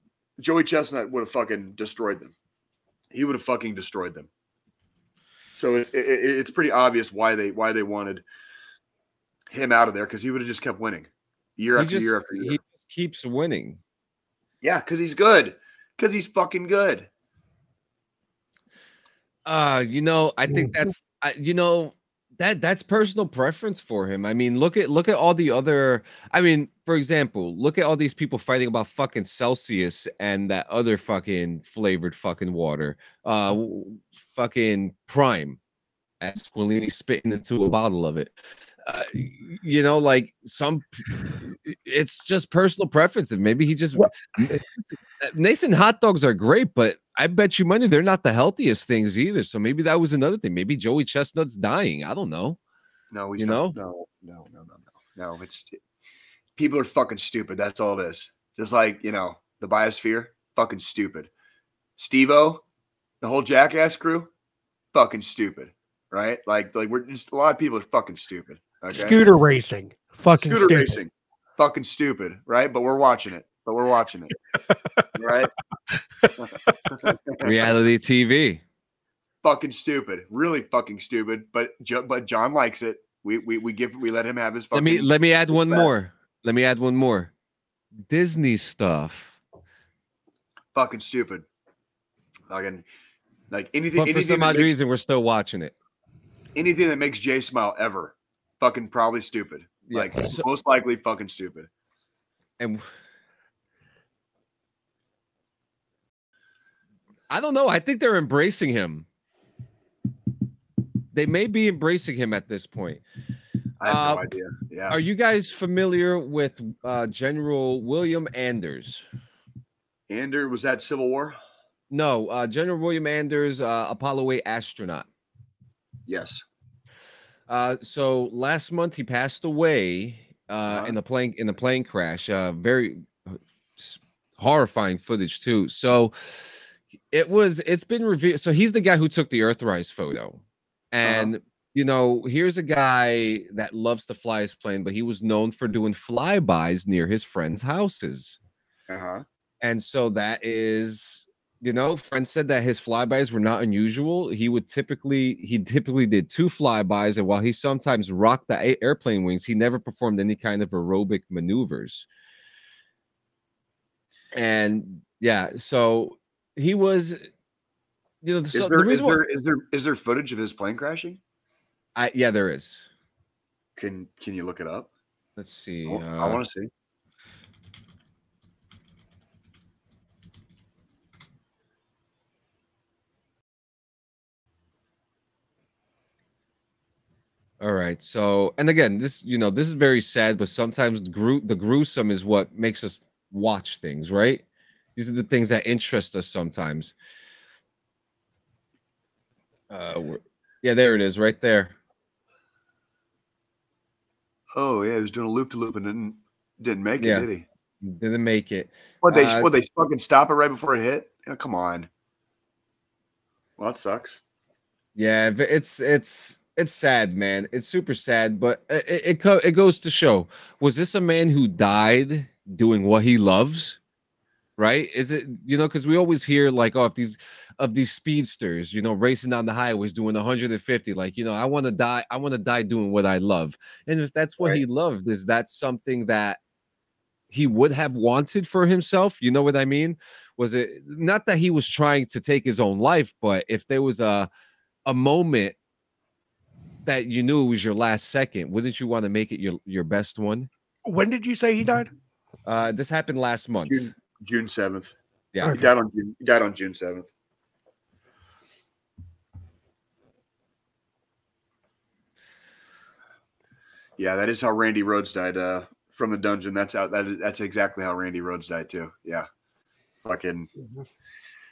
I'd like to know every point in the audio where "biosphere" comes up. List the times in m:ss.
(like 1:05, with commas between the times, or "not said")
0:59.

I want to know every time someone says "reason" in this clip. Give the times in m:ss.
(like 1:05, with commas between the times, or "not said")
1:34.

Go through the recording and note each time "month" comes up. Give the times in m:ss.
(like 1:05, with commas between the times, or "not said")
2:08, 4:13.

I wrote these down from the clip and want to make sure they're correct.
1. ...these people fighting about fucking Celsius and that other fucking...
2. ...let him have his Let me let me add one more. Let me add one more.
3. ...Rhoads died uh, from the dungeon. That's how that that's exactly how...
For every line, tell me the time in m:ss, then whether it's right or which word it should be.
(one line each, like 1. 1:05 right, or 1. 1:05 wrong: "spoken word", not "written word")
1. 0:27 right
2. 1:24 right
3. 4:24 right.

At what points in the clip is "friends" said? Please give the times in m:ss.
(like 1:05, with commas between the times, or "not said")
2:27, 2:31.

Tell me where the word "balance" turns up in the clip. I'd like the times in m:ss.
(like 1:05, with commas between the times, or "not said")
not said.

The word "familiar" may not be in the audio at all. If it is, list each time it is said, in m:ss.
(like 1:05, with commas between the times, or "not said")
1:55.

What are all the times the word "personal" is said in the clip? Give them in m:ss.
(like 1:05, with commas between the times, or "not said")
0:22, 0:42.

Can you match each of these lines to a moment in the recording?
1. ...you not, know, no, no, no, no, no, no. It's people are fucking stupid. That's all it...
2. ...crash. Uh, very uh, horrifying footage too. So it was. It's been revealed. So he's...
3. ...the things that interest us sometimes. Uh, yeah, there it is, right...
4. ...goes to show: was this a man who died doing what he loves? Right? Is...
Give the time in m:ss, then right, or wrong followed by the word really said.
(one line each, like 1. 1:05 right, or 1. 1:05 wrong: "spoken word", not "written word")
1. 0:53 right
2. 2:11 right
3. 3:15 right
4. 3:39 right.